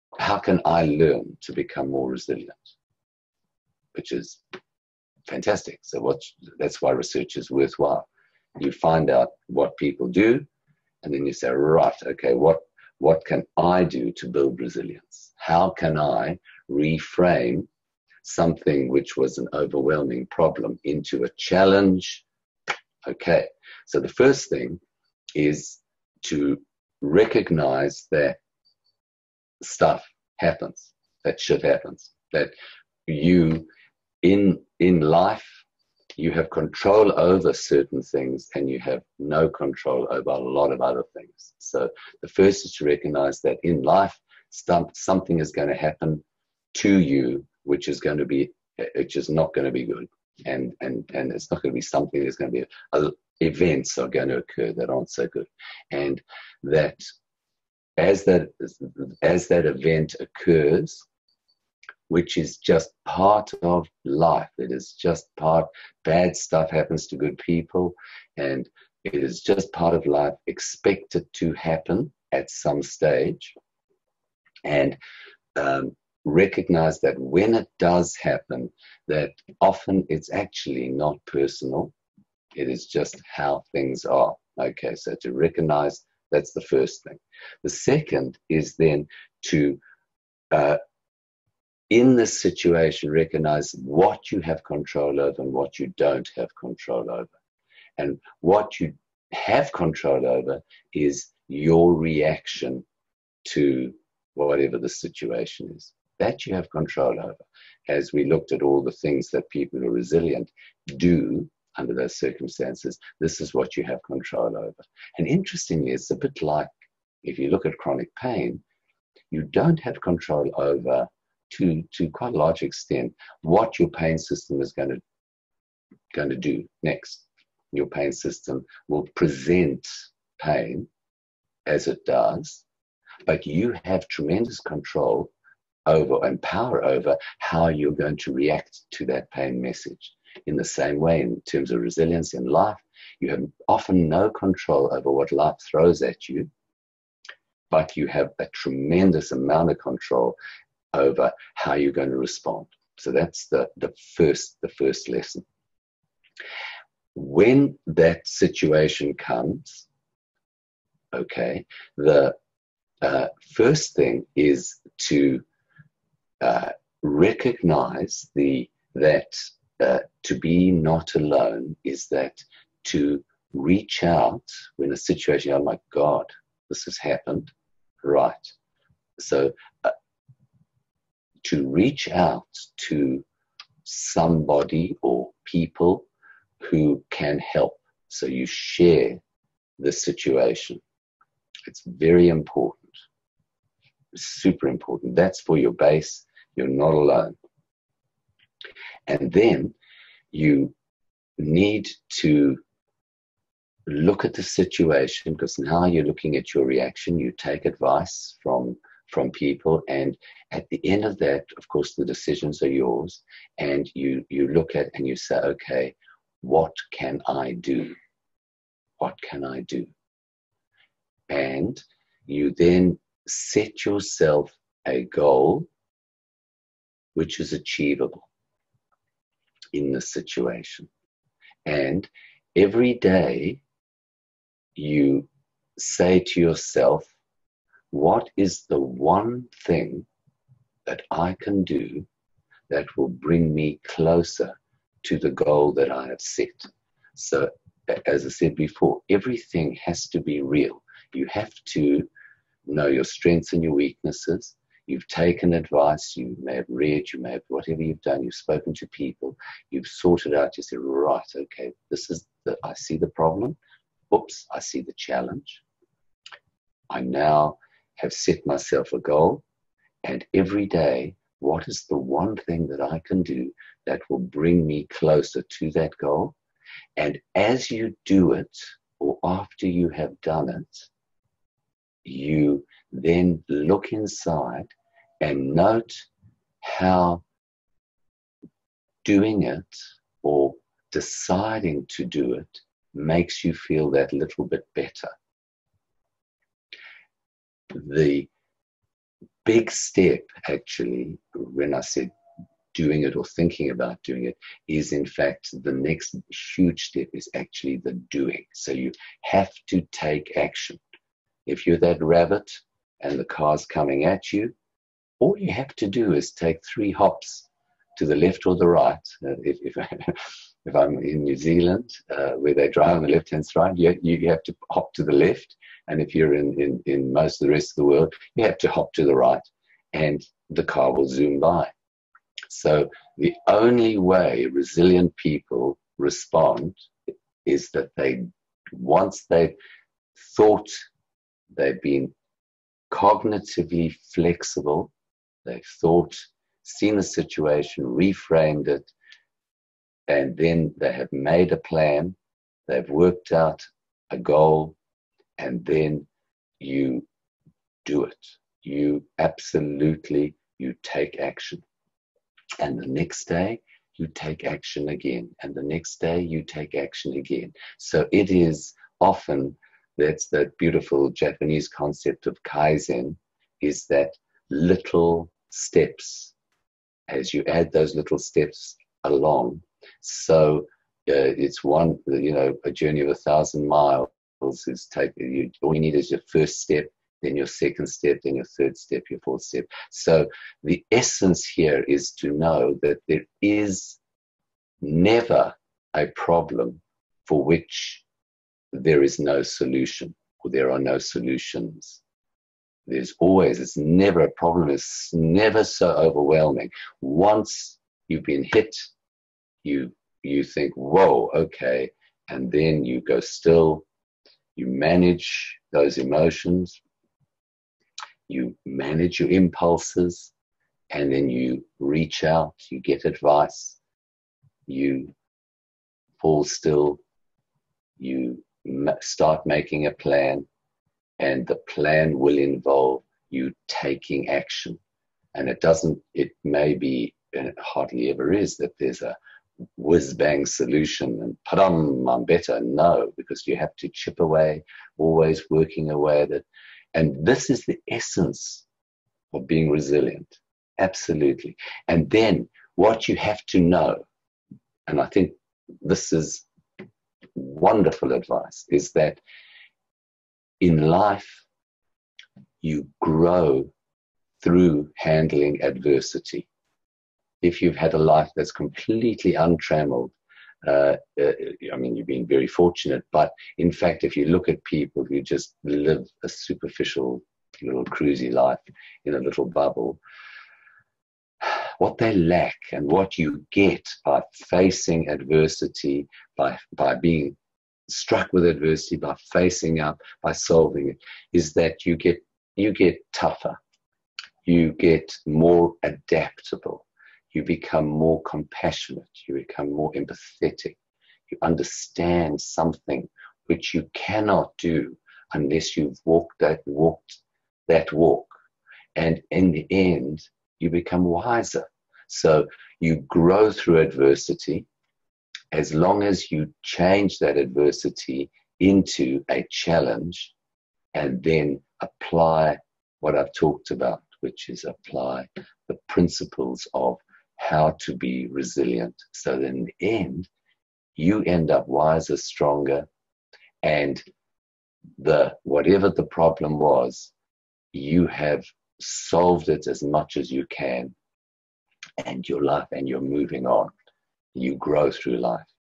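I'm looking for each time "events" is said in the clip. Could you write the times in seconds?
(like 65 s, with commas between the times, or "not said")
53 s, 59 s.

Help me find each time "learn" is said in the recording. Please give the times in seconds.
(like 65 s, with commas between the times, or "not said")
0 s.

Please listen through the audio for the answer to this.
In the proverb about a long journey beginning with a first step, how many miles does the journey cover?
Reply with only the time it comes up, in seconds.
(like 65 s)
383 s.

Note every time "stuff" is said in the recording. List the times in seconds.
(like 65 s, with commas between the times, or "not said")
29 s, 66 s.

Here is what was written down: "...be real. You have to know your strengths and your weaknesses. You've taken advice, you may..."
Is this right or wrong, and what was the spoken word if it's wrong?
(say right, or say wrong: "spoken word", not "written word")
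right.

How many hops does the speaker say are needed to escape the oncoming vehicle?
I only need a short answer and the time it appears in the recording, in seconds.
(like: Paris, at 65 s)
3, at 316 s.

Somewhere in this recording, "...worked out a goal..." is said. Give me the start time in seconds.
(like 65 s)
352 s.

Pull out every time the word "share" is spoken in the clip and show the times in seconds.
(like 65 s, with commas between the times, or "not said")
188 s.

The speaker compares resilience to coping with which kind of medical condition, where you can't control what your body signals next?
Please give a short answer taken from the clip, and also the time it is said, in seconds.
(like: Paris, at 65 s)
Chronic pain, at 117 s.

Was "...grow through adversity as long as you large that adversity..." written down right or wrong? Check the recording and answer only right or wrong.
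wrong.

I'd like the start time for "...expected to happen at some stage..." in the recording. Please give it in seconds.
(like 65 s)
70 s.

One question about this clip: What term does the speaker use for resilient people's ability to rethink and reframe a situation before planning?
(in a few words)
Cognitively flexible.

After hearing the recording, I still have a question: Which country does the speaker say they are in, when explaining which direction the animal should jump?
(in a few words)
New Zealand.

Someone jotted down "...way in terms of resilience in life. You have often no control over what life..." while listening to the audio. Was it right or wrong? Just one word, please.
right.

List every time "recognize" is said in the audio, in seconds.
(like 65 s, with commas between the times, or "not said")
27 s, 42 s, 76 s, 85 s, 93 s, 167 s.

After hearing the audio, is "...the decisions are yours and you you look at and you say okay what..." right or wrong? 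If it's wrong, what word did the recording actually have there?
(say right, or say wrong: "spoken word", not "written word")
right.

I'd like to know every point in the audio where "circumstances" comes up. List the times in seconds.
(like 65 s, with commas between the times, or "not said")
112 s.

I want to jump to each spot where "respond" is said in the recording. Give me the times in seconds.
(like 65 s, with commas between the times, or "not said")
152 s, 335 s.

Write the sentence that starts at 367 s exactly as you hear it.
So it is often that's that beautiful Japanese concept of kaizen, is that little steps.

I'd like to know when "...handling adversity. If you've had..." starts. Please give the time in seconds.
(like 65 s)
464 s.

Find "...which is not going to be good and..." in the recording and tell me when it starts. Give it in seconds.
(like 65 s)
48 s.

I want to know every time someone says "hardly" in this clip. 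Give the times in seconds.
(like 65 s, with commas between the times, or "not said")
437 s.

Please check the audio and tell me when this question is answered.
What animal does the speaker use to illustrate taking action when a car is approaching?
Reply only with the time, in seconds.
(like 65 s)
312 s.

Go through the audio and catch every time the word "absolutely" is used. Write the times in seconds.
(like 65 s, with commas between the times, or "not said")
359 s, 450 s.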